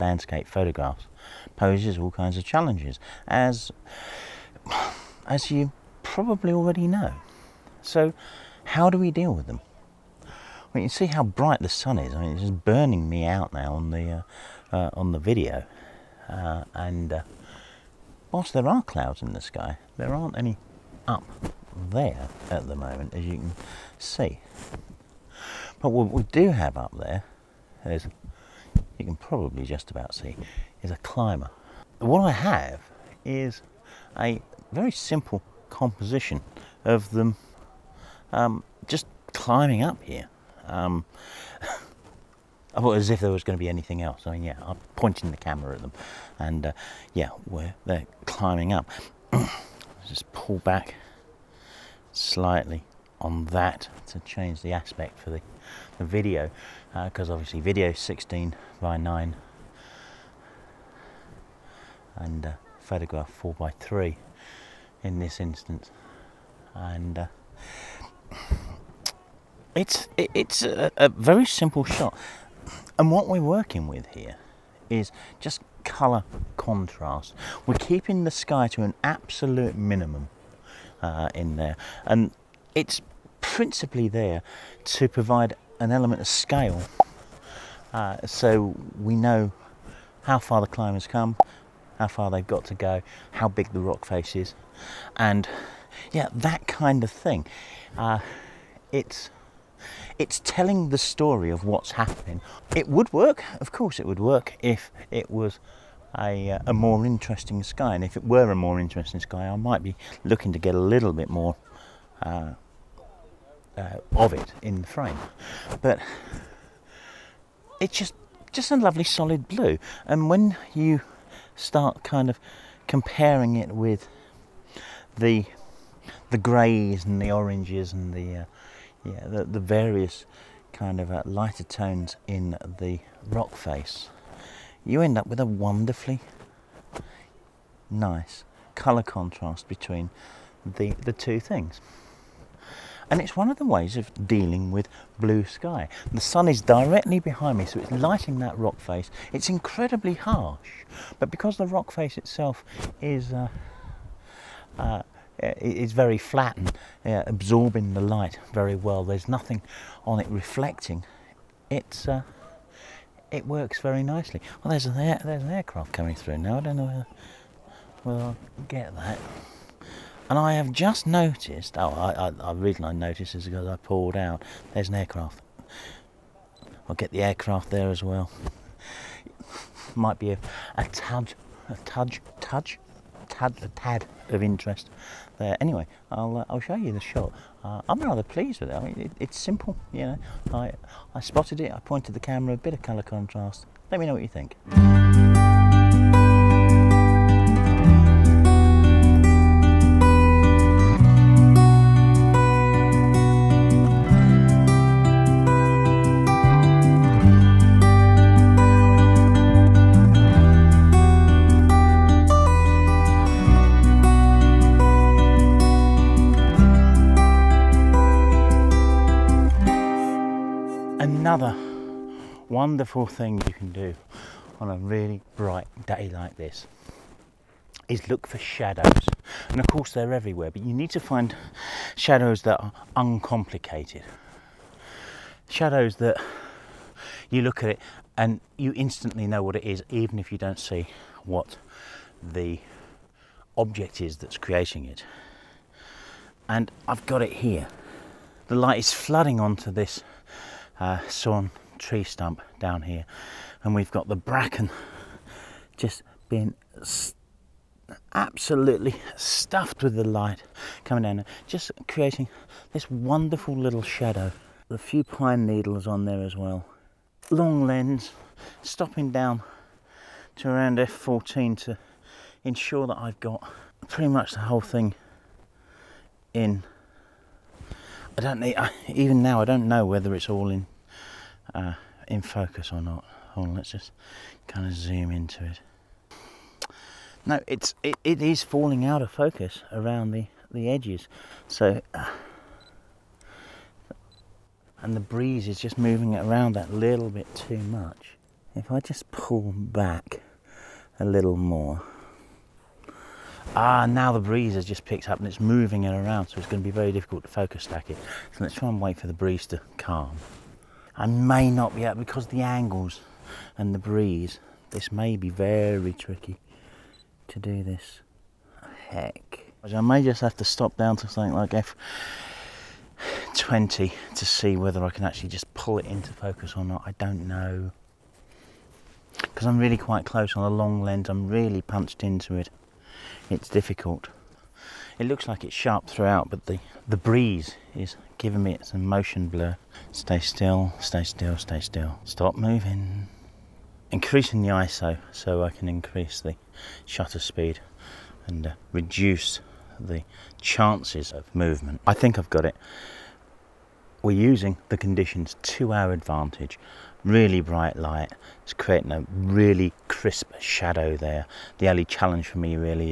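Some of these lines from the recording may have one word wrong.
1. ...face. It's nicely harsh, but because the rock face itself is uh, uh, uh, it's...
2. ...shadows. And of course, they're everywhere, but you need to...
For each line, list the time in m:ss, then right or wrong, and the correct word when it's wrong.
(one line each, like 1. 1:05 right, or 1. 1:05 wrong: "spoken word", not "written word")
1. 2:28 wrong: "incredibly", not "nicely"
2. 3:48 right.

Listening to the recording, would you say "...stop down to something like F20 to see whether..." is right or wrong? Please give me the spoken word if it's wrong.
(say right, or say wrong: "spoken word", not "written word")
right.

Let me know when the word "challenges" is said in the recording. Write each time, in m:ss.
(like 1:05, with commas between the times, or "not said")
0:02, 6:01.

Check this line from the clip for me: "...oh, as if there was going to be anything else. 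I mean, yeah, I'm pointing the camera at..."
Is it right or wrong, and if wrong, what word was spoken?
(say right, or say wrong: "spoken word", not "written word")
right.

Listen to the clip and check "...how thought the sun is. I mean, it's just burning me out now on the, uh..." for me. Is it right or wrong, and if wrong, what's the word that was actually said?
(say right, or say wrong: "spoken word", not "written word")
wrong: "bright", not "thought".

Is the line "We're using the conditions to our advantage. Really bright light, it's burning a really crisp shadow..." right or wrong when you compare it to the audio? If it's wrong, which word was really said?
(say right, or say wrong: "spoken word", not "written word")
wrong: "creating", not "burning".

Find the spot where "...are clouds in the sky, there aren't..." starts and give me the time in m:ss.
0:18.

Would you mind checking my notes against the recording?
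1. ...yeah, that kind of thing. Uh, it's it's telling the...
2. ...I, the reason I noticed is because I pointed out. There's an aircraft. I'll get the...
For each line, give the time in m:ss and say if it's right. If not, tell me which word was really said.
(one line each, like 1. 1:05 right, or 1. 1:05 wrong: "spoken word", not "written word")
1. 1:36 right
2. 2:52 wrong: "pulled", not "pointed".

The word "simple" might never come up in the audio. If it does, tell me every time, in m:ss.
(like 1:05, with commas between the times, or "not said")
0:34, 1:11, 3:09.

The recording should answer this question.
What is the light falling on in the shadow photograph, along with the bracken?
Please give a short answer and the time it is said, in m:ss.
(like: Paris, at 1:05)
Sawn tree stump, at 4:11.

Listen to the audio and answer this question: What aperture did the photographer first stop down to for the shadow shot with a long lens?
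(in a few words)
f14.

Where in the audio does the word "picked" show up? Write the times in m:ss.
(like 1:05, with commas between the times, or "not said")
5:04.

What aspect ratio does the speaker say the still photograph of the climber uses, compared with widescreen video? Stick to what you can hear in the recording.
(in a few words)
4 by 3.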